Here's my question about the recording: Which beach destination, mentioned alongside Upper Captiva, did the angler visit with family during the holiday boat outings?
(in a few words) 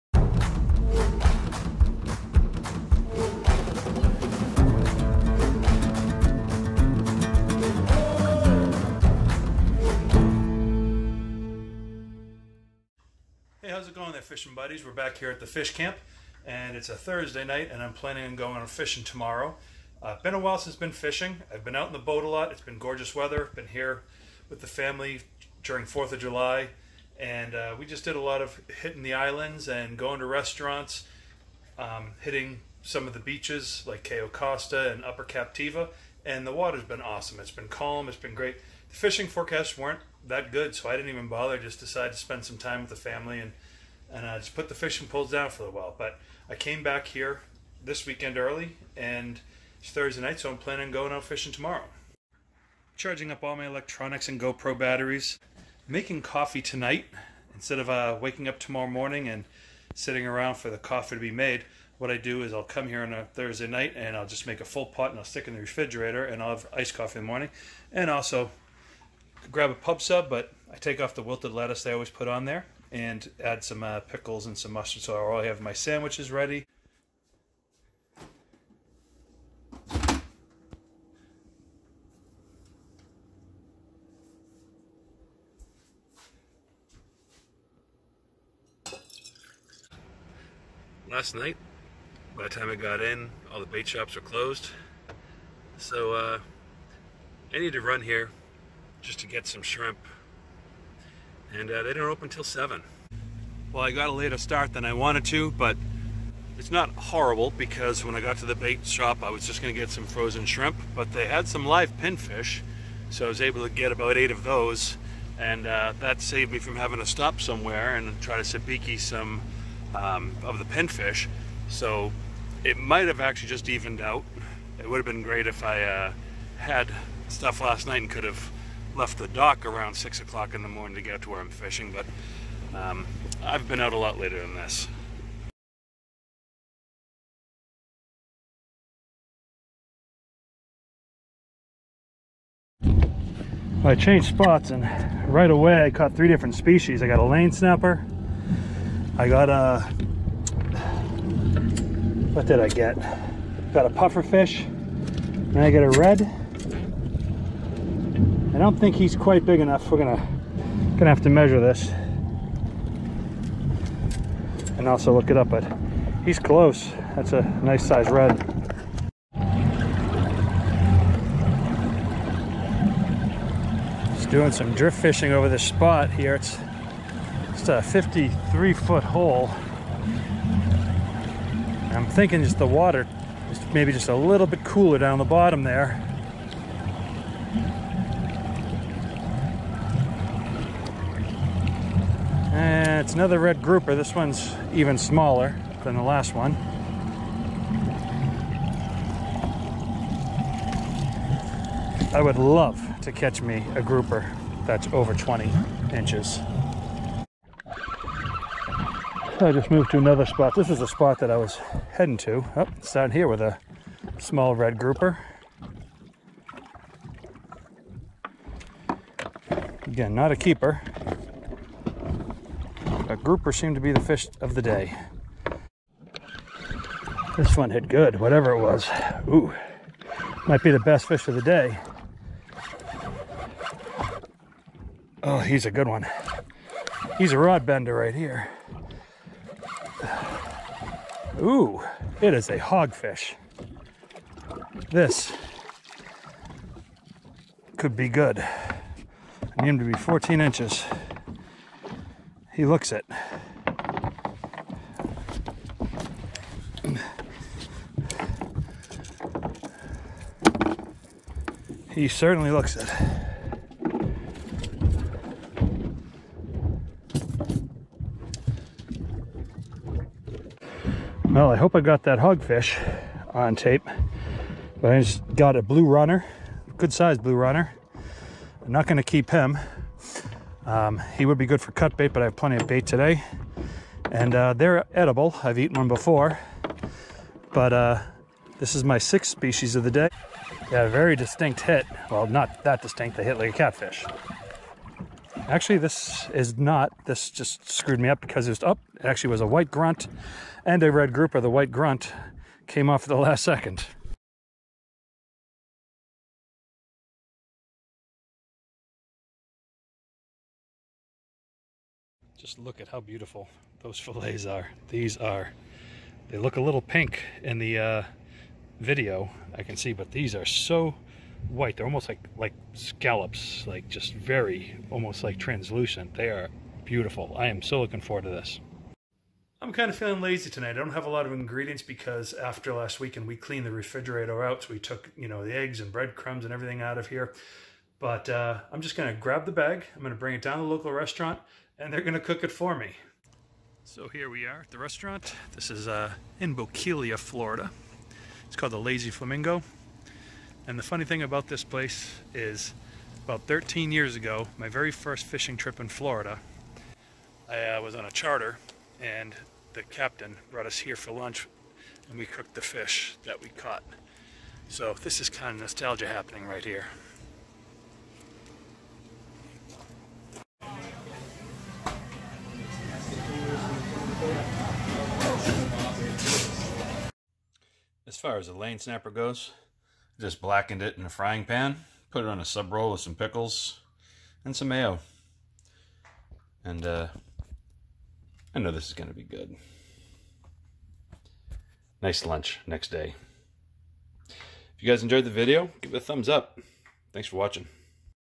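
Cayo Costa.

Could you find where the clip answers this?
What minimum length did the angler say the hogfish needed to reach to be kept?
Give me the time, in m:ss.
4:09.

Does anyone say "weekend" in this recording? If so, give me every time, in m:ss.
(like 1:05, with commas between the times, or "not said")
0:48, 5:32.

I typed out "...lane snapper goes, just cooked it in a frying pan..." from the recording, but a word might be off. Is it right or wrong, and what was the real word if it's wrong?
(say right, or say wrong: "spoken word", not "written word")
wrong: "blackened", not "cooked".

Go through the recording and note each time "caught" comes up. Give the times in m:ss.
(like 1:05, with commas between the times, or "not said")
2:25, 6:03.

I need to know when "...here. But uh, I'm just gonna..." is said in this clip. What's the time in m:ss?
5:37.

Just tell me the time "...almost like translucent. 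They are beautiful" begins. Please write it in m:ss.
5:24.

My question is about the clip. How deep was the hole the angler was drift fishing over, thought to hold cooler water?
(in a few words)
53 feet.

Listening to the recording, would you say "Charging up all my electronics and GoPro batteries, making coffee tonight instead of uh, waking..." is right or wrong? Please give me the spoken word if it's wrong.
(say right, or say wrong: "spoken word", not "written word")
right.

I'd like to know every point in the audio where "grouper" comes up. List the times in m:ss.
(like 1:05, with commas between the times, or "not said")
3:13, 3:23, 3:34, 3:43, 5:01.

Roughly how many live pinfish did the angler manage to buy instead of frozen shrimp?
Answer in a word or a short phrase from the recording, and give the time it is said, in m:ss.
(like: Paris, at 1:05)
8, at 1:54.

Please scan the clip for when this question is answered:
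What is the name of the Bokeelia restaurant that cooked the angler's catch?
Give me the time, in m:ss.
5:48.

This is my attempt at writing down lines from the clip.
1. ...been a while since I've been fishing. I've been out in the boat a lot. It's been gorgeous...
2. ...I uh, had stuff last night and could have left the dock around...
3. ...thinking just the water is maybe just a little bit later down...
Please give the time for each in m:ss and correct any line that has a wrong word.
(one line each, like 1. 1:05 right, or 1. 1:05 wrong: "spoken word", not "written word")
1. 0:20 right
2. 2:05 right
3. 3:02 wrong: "cooler", not "later".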